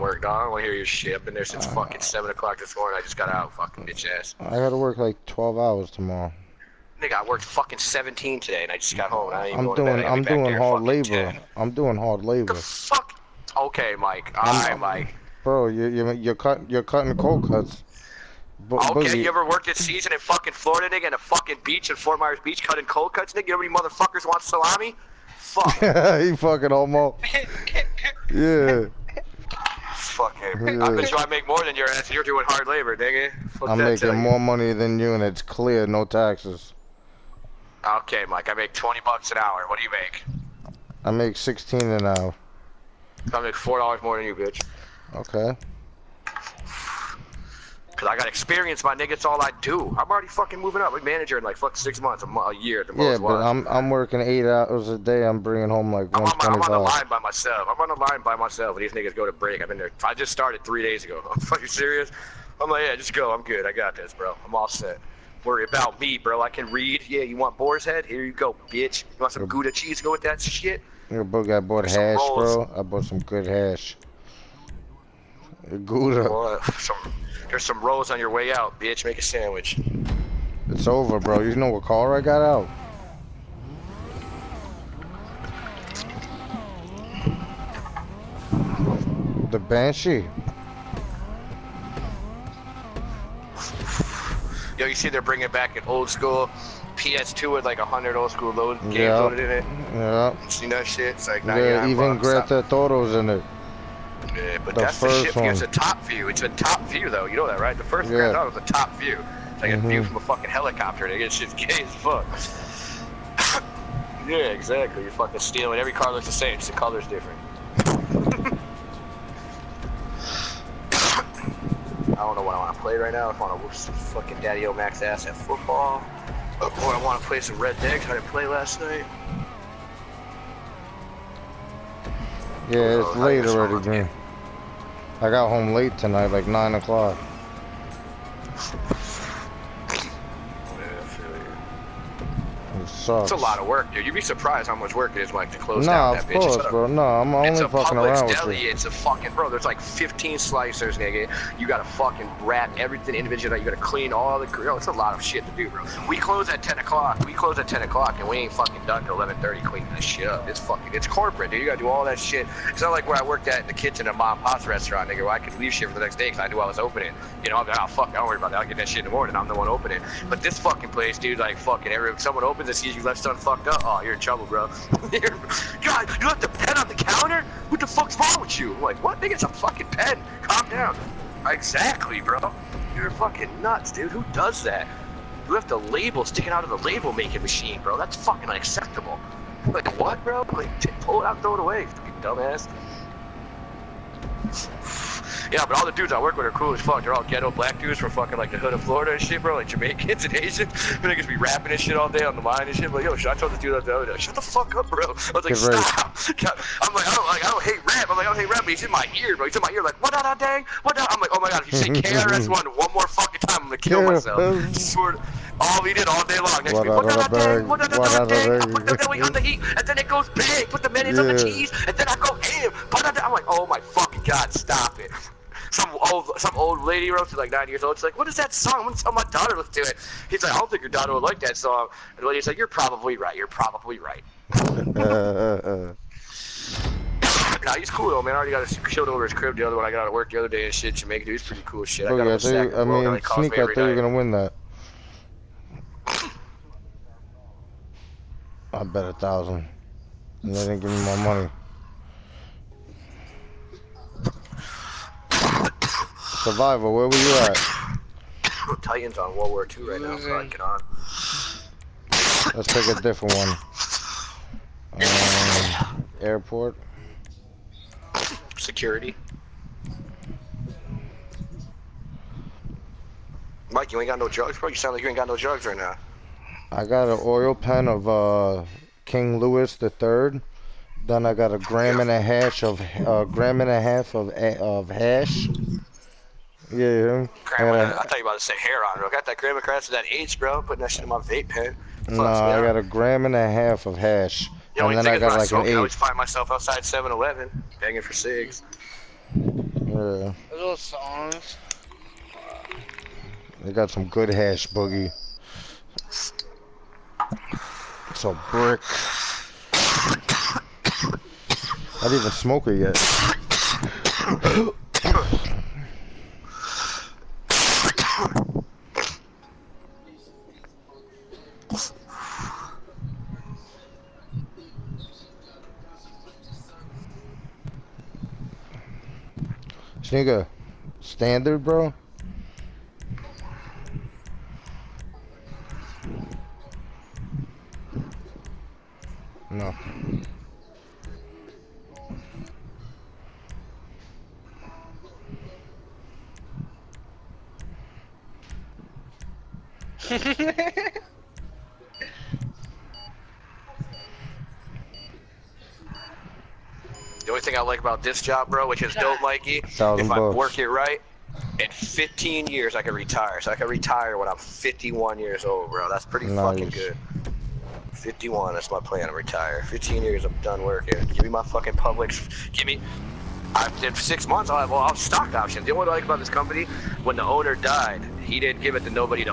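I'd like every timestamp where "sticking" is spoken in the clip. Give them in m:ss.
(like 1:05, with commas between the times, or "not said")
3:06.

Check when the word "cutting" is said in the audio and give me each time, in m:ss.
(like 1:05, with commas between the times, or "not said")
0:16, 0:22.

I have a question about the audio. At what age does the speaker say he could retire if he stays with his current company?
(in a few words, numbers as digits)
51.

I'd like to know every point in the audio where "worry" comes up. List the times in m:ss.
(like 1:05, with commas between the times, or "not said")
1:05, 2:48.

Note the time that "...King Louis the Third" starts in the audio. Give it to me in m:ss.
4:39.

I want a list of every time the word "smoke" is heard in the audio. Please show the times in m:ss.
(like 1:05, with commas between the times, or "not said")
5:12.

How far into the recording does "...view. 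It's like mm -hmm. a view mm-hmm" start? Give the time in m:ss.
1:48.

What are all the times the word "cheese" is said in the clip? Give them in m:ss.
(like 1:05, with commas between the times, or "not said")
1:09, 3:41.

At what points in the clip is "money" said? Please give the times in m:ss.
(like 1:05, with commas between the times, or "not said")
0:34, 4:11.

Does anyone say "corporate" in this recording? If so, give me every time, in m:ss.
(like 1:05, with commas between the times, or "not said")
2:41.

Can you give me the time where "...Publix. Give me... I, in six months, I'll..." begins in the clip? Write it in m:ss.
6:11.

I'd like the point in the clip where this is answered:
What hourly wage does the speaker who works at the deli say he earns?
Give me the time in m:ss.
0:38.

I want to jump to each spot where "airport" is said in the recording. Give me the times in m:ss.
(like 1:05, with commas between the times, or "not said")
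4:26.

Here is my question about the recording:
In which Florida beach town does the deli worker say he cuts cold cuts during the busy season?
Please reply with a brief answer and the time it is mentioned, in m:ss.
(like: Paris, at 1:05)
Fort Myers Beach, at 0:21.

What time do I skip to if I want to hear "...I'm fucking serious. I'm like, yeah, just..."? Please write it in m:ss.
1:01.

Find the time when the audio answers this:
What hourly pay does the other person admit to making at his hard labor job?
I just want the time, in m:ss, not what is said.
0:41.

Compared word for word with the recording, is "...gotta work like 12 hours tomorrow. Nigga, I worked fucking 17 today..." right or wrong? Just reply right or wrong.
right.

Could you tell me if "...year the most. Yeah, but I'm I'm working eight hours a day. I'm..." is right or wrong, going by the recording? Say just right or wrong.
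right.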